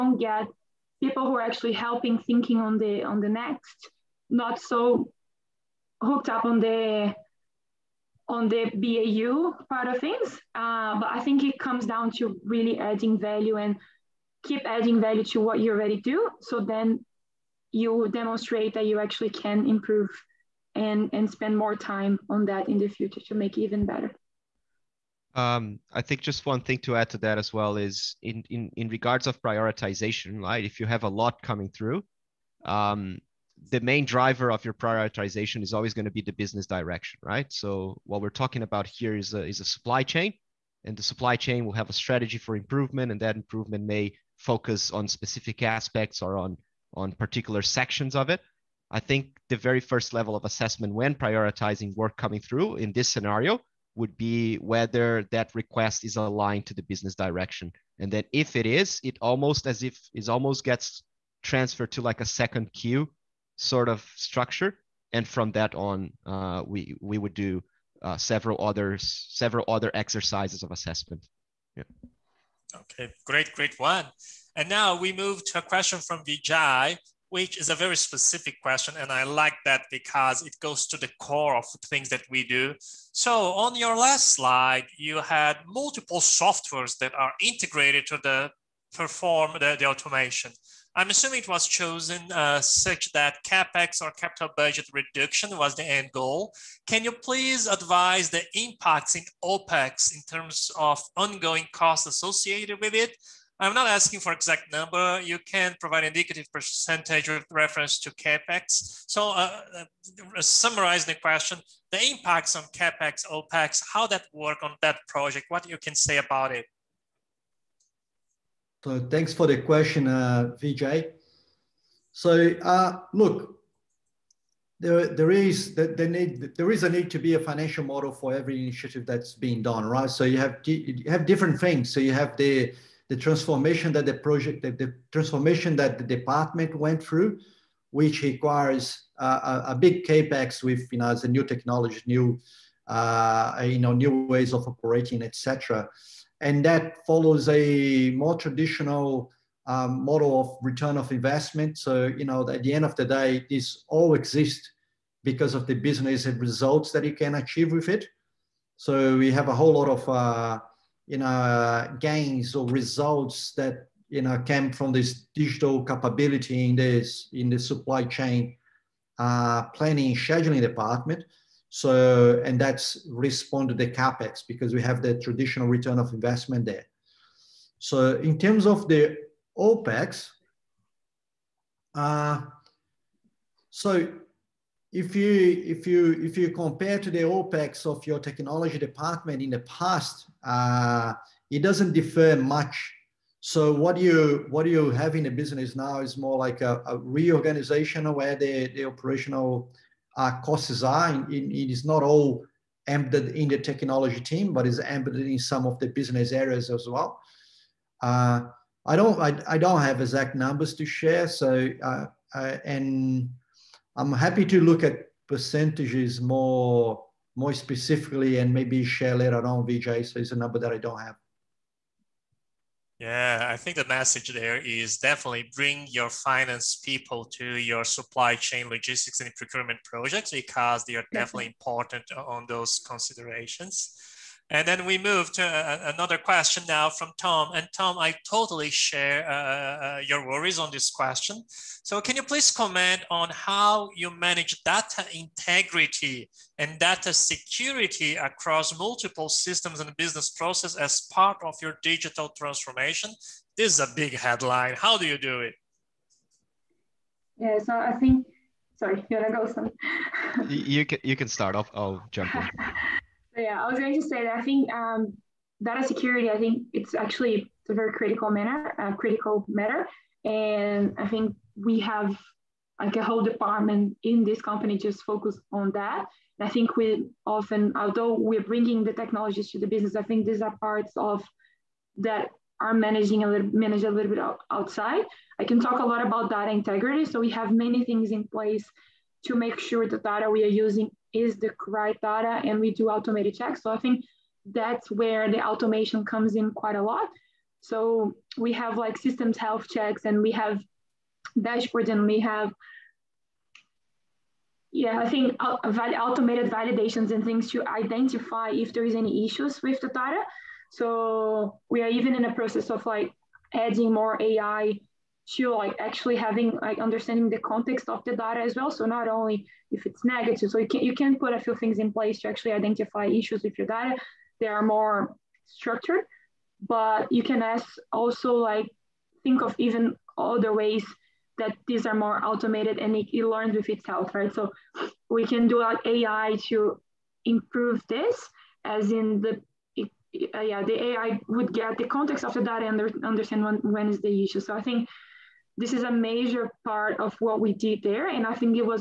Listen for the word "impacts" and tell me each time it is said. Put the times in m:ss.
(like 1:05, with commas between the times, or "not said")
1:38, 1:52.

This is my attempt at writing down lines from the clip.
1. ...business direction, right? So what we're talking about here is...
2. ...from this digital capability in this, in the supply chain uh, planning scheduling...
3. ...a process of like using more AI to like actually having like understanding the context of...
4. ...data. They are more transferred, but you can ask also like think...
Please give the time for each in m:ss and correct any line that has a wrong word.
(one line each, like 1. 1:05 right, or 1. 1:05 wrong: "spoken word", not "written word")
1. 0:36 right
2. 2:44 right
3. 5:12 wrong: "adding", not "using"
4. 5:23 wrong: "structured", not "transferred".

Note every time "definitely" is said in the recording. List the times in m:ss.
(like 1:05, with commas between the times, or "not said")
3:44, 3:51.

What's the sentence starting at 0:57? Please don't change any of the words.
And then if it is, it almost as if it almost gets transferred to like a second queue sort of structure.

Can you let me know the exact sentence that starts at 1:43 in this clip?
I'm not asking for exact number.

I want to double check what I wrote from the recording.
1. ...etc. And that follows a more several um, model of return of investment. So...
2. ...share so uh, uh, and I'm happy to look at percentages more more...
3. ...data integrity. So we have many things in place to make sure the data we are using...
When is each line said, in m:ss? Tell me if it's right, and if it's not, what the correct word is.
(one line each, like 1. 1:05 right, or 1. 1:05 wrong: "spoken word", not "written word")
1. 2:25 wrong: "traditional", not "several"
2. 3:30 right
3. 4:46 right.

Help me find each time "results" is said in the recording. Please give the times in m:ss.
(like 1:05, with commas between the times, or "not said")
2:36, 2:42.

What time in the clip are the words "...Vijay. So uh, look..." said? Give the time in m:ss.
2:00.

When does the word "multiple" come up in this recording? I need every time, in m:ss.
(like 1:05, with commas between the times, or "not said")
1:25, 4:08.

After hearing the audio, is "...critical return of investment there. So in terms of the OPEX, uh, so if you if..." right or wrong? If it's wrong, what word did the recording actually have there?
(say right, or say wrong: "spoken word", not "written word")
wrong: "traditional", not "critical".